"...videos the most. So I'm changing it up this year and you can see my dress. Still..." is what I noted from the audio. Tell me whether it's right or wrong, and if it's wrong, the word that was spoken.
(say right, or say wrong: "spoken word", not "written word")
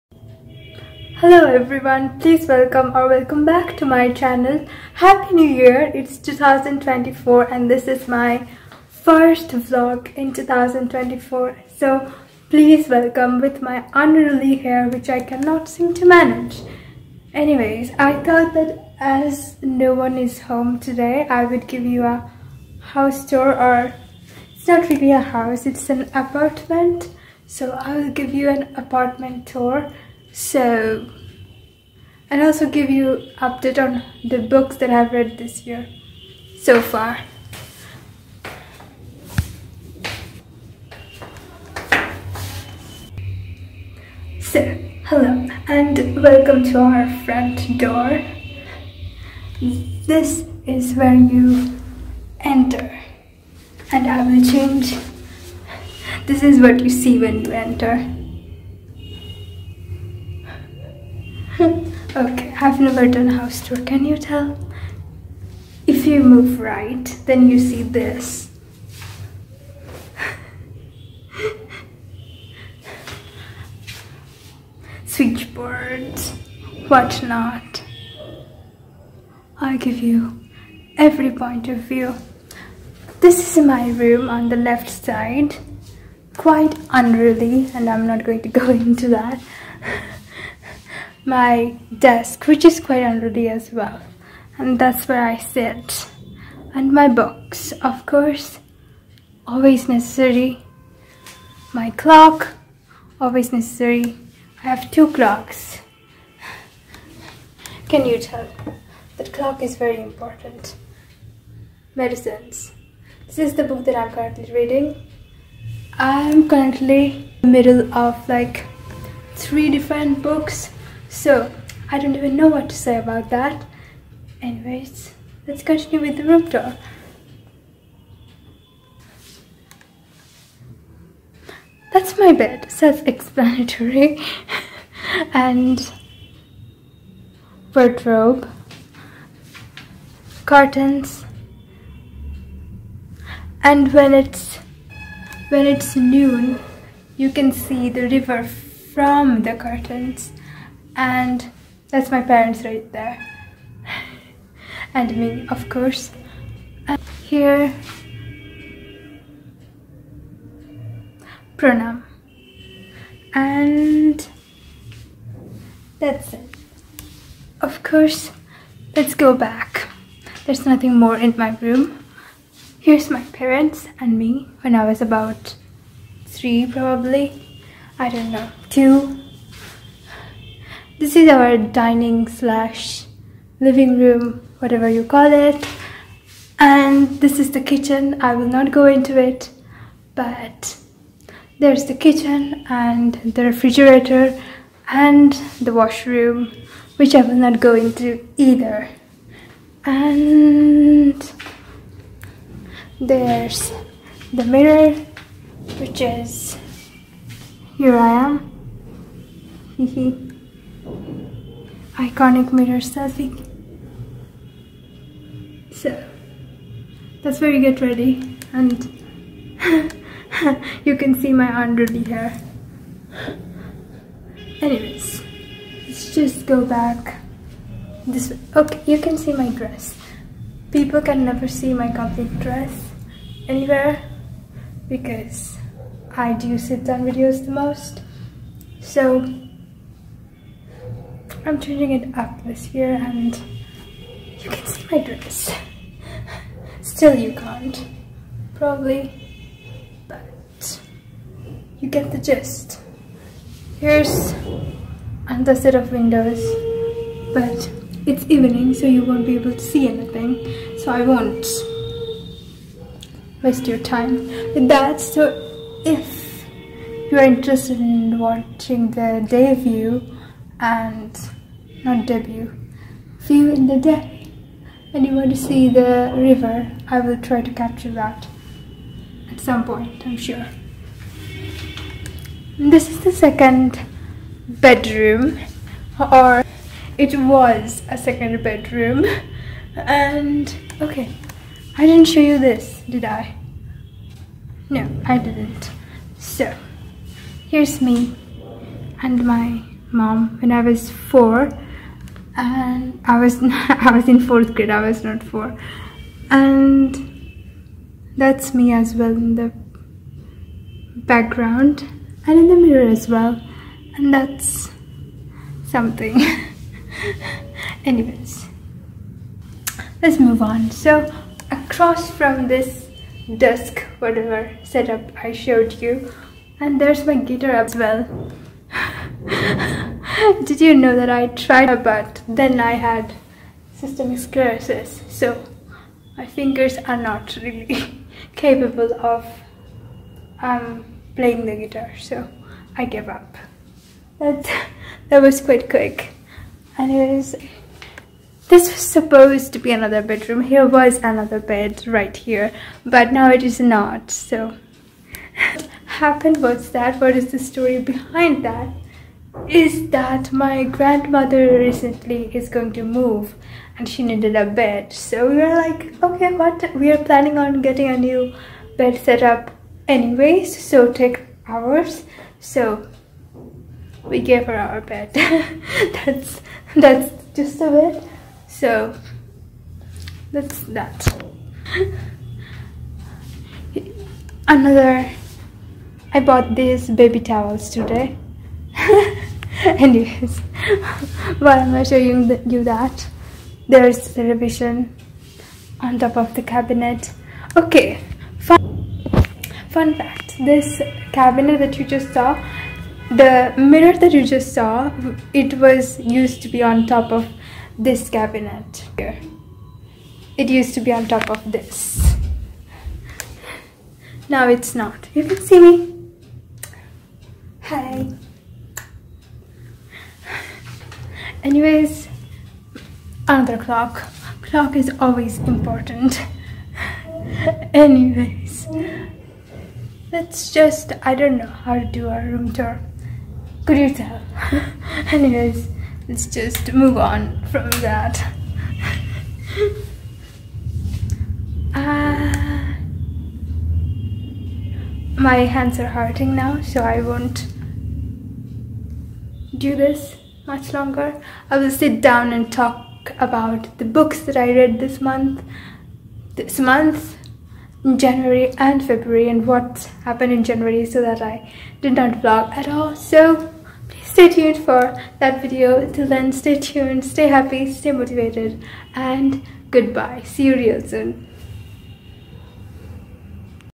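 right.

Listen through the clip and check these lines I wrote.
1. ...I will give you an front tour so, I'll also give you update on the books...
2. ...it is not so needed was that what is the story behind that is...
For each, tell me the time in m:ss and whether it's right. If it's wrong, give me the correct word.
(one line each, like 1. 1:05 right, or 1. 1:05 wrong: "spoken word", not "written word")
1. 0:27 wrong: "apartment", not "front"
2. 5:53 wrong: "happened", not "needed".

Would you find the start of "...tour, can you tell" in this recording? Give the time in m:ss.
1:03.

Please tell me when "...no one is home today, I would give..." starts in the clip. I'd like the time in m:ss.
0:19.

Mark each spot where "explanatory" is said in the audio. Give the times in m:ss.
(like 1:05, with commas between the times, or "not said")
2:12.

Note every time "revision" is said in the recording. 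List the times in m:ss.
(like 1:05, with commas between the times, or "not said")
6:34.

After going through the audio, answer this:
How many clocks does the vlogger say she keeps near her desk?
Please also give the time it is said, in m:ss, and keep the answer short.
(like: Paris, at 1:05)
2, at 1:44.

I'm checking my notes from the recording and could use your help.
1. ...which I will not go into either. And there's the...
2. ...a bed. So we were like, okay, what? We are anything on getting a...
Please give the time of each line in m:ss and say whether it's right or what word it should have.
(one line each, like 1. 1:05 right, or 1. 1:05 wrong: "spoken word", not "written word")
1. 3:16 right
2. 6:04 wrong: "planning", not "anything".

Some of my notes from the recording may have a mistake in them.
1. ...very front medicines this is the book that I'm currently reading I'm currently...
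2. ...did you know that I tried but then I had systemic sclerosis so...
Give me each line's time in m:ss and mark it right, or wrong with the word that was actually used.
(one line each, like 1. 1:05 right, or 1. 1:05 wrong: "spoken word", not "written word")
1. 1:49 wrong: "important", not "front"
2. 5:30 right.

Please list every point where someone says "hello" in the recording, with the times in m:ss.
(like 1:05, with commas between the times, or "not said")
0:01, 0:45.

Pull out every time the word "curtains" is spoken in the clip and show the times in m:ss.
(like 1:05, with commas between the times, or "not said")
2:20, 2:29.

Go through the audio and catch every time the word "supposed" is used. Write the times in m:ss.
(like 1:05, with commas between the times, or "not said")
5:48.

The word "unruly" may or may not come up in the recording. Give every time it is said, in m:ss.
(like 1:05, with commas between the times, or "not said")
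0:13, 1:26, 1:33, 3:41.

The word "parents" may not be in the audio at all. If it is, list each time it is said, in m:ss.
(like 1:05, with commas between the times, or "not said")
2:32, 2:53.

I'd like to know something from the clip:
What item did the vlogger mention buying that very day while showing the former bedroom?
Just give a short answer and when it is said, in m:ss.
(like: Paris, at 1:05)
baby towels, at 6:26.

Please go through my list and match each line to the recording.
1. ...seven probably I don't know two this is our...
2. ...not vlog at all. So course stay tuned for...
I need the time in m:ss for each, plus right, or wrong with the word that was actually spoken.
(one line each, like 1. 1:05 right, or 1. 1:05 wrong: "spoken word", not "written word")
1. 2:56 wrong: "three", not "seven"
2. 7:42 wrong: "please", not "course".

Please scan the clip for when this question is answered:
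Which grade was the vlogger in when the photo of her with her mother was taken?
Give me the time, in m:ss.
5:04.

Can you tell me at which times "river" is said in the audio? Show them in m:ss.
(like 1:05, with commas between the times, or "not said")
2:28, 4:36.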